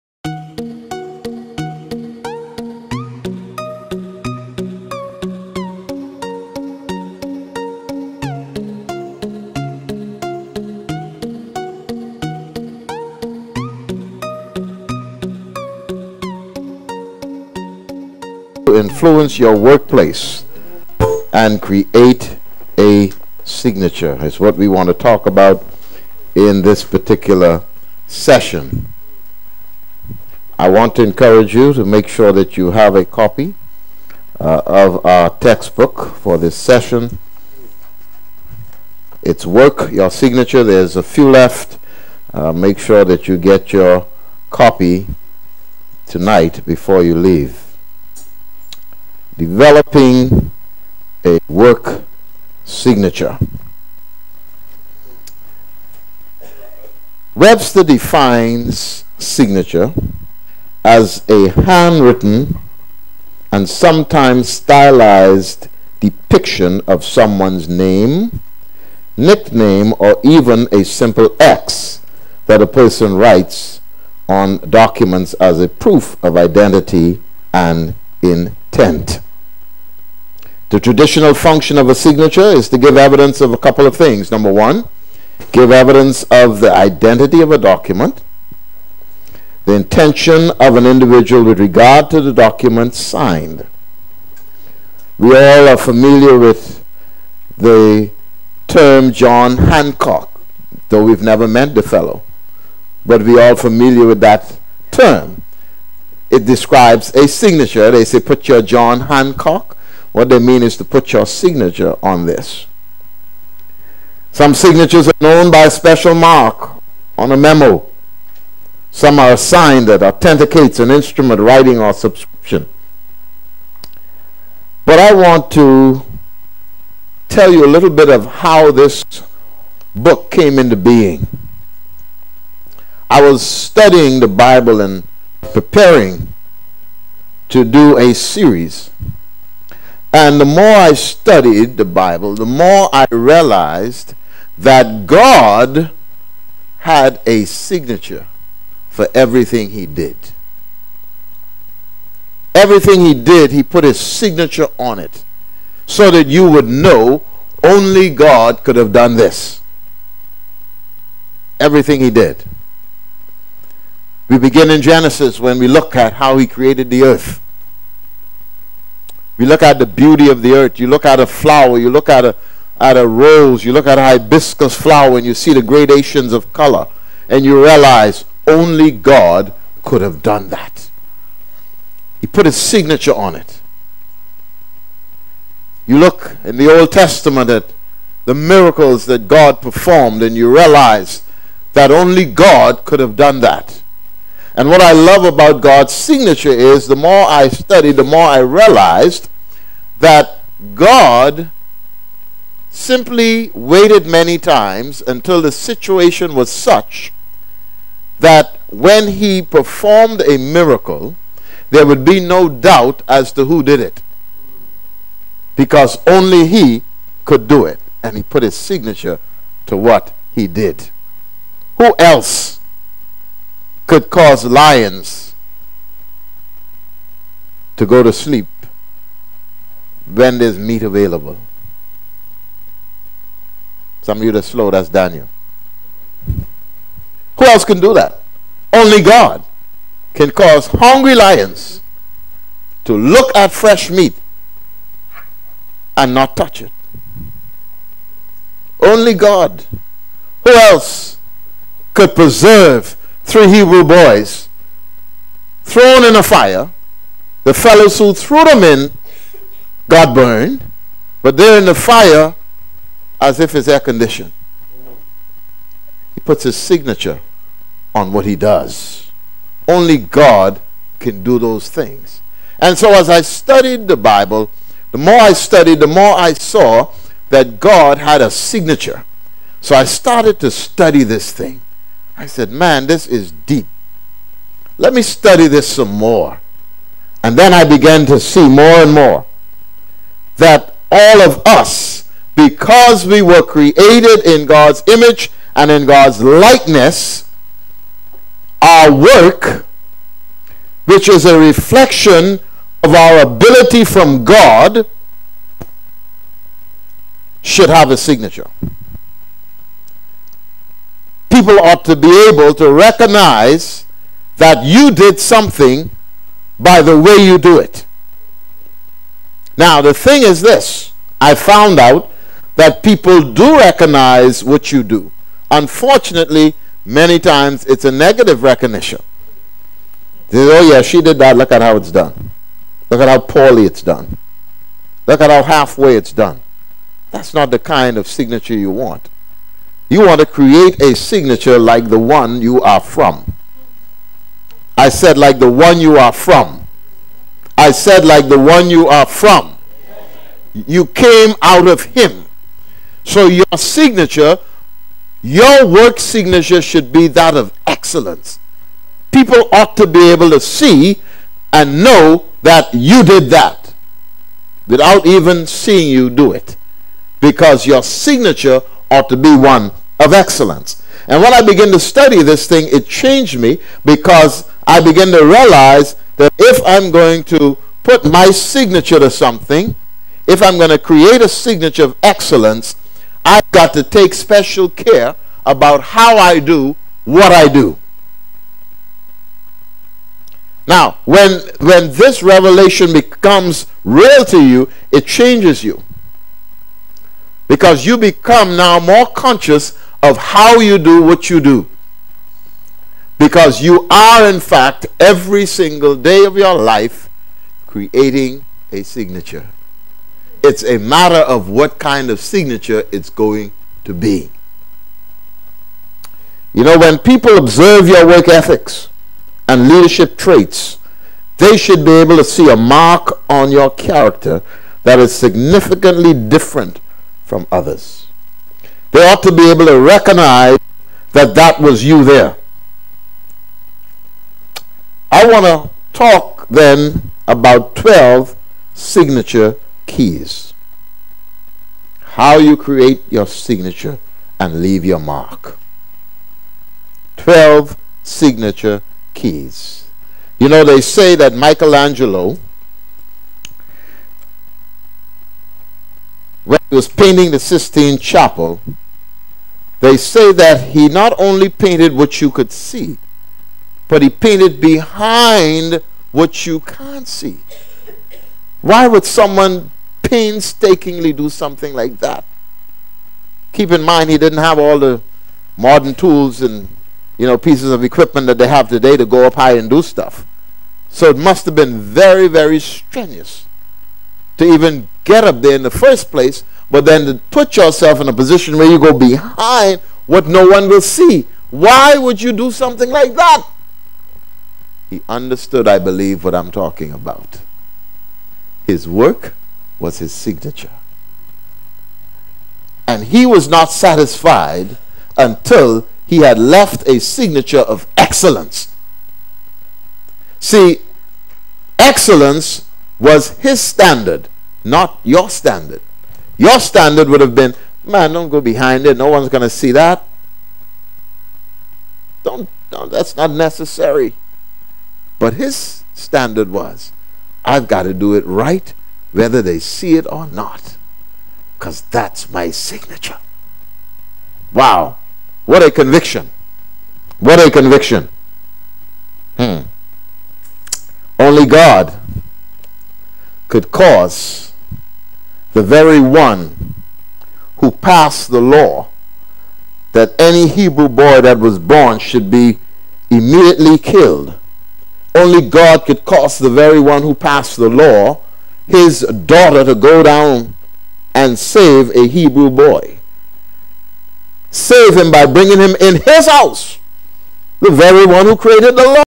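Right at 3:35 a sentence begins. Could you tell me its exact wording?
Because only he could do it.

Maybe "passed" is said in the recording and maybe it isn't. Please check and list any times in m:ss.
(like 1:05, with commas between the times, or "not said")
9:07, 9:17.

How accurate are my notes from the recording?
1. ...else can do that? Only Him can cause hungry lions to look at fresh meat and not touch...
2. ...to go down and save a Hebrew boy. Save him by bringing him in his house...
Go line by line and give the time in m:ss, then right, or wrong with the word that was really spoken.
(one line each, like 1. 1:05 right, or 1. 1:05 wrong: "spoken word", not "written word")
1. 3:57 wrong: "God", not "Him"
2. 9:19 right.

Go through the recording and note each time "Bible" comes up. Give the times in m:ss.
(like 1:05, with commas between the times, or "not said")
2:14, 2:21, 4:33.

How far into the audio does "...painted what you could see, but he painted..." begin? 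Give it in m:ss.
7:41.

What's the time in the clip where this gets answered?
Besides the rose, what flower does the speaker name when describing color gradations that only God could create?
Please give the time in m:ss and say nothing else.
2:54.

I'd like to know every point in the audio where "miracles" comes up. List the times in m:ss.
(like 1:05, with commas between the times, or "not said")
3:08, 3:30.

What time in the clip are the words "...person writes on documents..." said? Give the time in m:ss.
1:12.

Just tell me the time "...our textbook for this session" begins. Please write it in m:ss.
0:35.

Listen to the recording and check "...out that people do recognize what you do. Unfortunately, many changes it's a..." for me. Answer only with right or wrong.
wrong.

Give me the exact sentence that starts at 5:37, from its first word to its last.
That's not the kind of signature you want.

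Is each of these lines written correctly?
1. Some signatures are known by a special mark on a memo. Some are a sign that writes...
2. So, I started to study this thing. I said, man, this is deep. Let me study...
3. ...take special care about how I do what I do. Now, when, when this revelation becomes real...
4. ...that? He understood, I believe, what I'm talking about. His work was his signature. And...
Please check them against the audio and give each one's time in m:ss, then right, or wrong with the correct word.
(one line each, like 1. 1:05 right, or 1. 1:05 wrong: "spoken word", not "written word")
1. 1:54 wrong: "authenticates", not "writes"
2. 4:39 right
3. 6:23 right
4. 8:13 right.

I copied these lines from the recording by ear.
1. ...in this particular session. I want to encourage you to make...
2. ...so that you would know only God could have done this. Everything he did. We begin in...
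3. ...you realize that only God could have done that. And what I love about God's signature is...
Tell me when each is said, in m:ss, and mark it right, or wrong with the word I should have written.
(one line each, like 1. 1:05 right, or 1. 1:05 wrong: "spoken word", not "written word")
1. 0:26 right
2. 2:35 right
3. 3:10 right.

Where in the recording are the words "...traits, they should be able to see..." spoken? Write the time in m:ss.
7:00.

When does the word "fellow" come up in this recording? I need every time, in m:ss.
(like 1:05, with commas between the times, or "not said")
1:41, 4:17.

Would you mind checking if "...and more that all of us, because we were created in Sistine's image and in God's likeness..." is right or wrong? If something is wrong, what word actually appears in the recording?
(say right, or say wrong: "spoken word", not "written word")
wrong: "God", not "Sistine".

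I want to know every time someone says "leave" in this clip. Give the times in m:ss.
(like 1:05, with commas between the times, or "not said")
0:47, 7:24.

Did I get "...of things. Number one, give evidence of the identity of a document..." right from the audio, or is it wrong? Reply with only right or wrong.
right.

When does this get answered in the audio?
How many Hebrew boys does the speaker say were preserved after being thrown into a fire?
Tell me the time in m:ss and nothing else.
4:13.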